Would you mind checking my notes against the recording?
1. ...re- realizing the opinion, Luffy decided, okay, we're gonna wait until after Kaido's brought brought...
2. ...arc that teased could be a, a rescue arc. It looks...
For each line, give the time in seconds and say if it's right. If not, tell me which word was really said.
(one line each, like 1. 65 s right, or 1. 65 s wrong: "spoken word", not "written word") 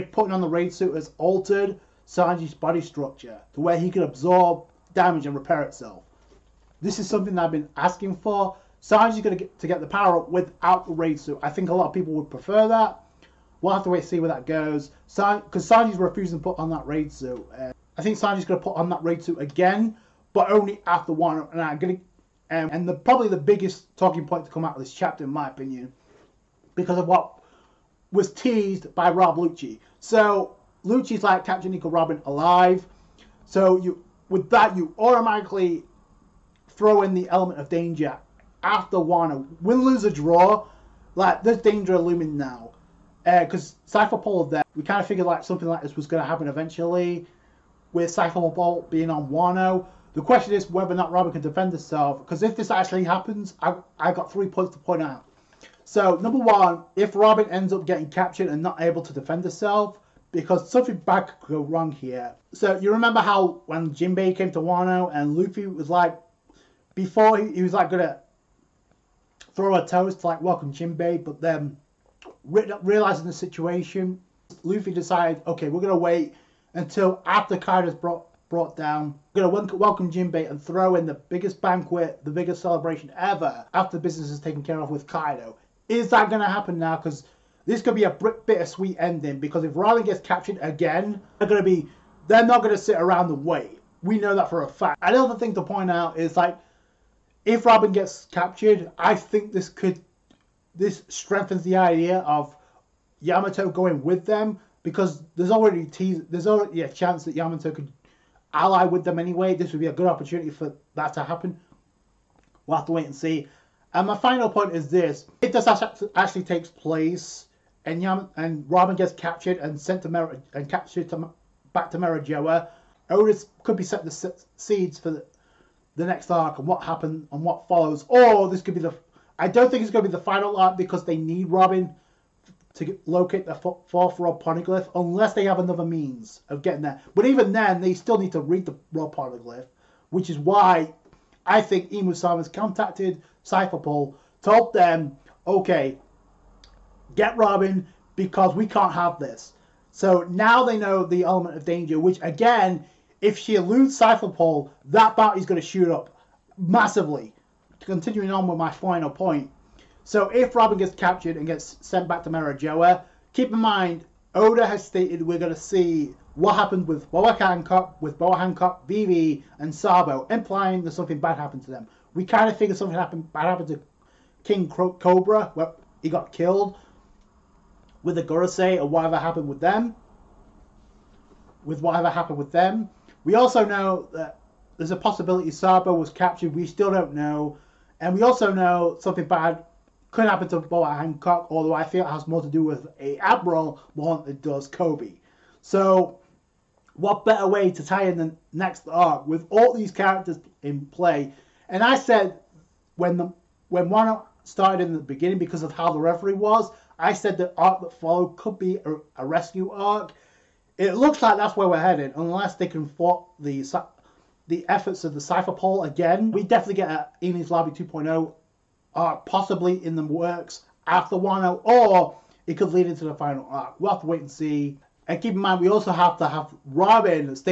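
1. 72 s wrong: "situation", not "opinion"
2. 207 s wrong: "followed", not "teased".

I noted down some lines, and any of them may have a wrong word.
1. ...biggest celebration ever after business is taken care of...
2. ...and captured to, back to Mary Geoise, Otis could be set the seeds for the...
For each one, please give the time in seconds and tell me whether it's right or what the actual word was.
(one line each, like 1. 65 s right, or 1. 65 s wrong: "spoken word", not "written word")
1. 82 s right
2. 120 s right.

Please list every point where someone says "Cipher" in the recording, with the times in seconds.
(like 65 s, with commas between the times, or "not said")
43 s, 48 s, 143 s, 153 s, 215 s.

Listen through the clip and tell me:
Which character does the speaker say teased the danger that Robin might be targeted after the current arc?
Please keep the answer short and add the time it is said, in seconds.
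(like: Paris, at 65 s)
Rob Lucci, at 29 s.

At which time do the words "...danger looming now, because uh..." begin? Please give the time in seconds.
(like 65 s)
41 s.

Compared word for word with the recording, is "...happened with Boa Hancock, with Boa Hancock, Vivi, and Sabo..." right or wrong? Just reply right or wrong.
right.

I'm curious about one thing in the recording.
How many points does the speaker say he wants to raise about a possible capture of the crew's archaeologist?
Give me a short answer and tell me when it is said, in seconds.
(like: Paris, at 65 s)
3, at 54 s.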